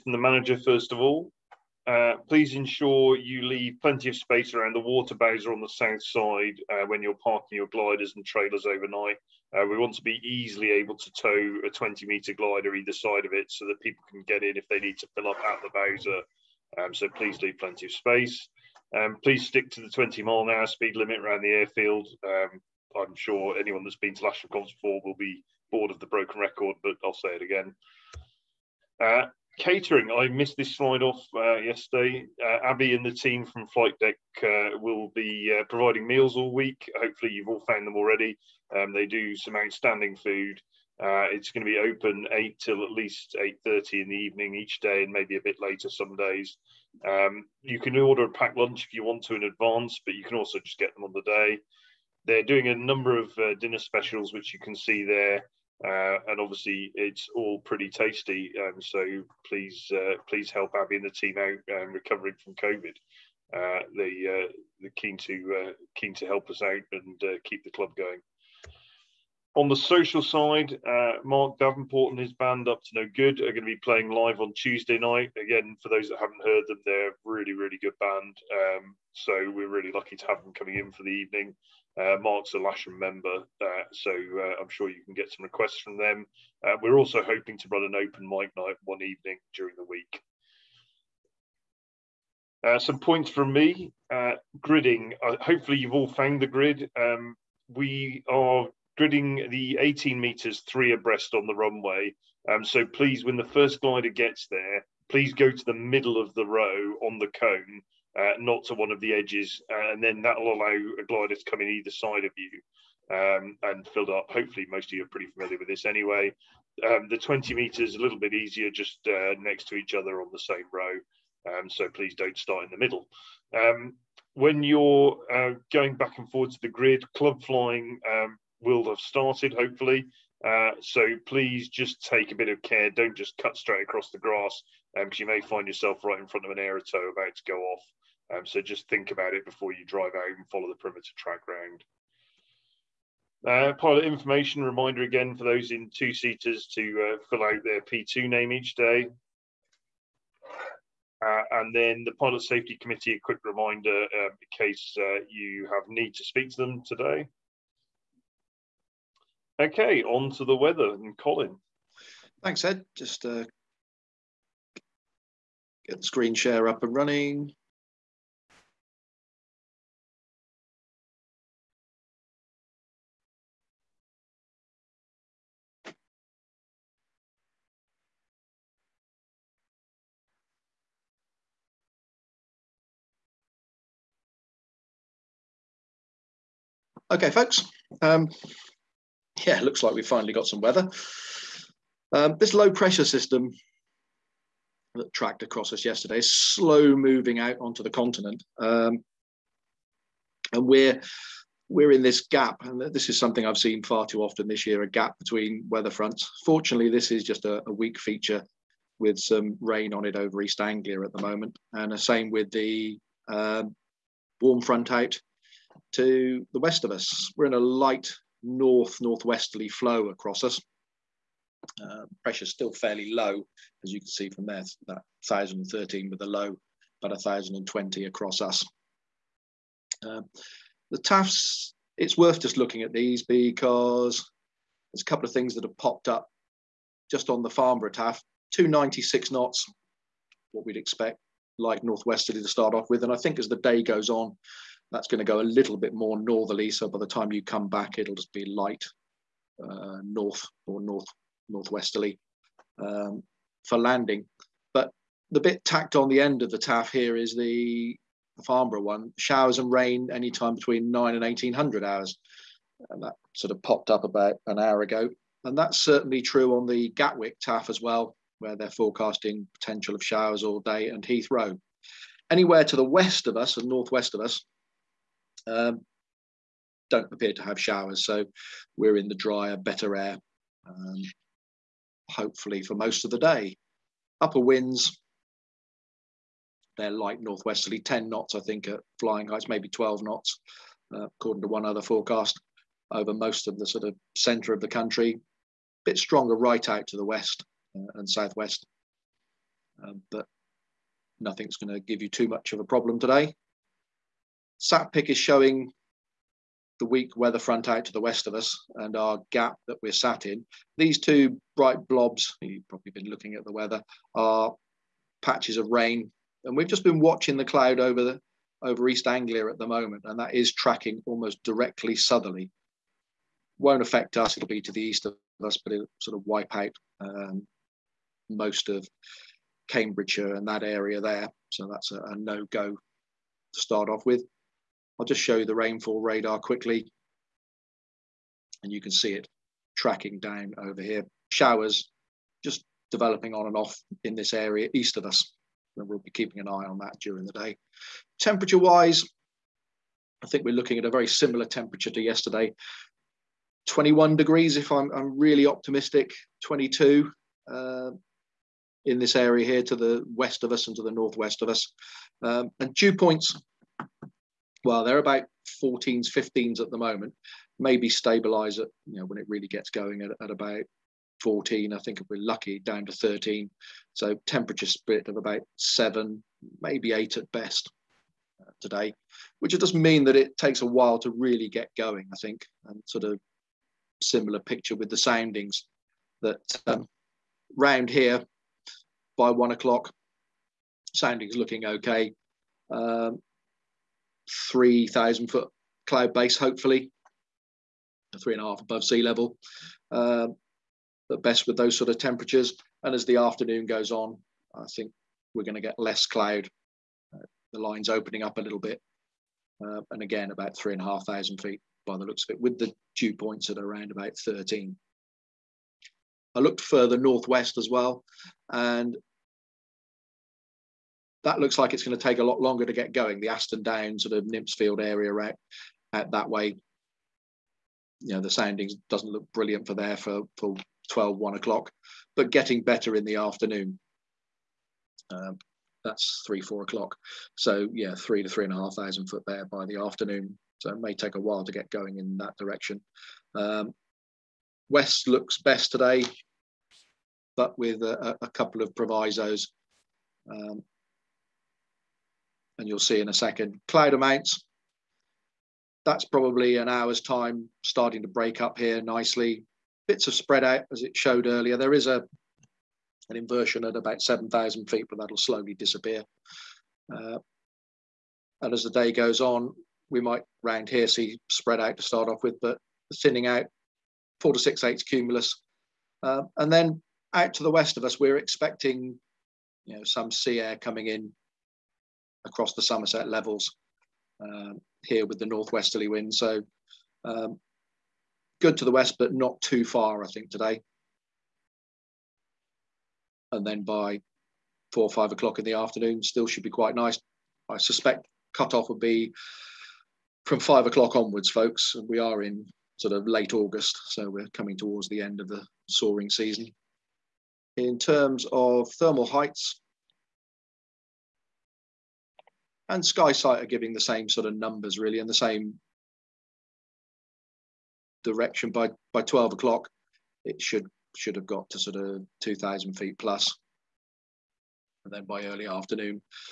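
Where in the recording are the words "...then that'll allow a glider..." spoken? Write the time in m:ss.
1:50.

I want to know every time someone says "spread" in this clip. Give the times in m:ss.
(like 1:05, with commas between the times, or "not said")
7:40, 7:51.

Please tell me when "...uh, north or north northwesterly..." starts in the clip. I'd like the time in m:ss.
4:09.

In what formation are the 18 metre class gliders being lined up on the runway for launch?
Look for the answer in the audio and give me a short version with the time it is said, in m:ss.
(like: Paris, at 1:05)
three abreast, at 1:40.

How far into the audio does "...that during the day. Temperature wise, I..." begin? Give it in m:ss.
5:46.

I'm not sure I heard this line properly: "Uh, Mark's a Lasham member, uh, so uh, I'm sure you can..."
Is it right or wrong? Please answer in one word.
right.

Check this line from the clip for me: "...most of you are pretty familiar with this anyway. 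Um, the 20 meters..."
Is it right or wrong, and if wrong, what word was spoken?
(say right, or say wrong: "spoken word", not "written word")
right.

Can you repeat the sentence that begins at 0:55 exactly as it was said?
Uh, and obviously, it's all pretty tasty.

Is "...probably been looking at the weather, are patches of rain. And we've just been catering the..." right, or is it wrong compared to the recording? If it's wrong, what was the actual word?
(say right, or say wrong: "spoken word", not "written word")
wrong: "watching", not "catering".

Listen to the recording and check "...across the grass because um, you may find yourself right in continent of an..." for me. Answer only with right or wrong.
wrong.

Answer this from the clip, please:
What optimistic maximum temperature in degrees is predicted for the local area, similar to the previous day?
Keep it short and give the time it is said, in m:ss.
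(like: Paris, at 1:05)
21, at 5:53.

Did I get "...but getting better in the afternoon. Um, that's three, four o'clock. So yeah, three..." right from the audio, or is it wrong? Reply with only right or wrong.
right.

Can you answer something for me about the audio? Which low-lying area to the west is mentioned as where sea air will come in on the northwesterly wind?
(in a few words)
Somerset levels.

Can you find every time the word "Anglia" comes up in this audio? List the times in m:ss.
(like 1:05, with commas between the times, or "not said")
3:30, 5:19.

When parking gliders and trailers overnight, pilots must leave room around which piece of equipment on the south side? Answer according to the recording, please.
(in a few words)
water bowser.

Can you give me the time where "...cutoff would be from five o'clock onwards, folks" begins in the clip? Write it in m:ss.
8:18.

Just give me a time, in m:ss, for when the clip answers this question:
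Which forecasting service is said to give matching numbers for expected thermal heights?
8:32.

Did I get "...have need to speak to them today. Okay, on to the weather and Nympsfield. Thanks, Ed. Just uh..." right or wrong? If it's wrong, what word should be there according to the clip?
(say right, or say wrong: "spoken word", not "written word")
wrong: "Colin", not "Nympsfield".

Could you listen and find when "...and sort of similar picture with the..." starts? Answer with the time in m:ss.
6:22.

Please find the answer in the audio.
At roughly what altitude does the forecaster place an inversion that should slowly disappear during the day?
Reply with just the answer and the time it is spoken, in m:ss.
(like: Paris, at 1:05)
7,000 feet, at 7:44.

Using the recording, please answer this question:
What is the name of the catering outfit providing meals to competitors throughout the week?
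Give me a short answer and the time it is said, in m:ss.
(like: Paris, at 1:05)
Flight Deck, at 0:33.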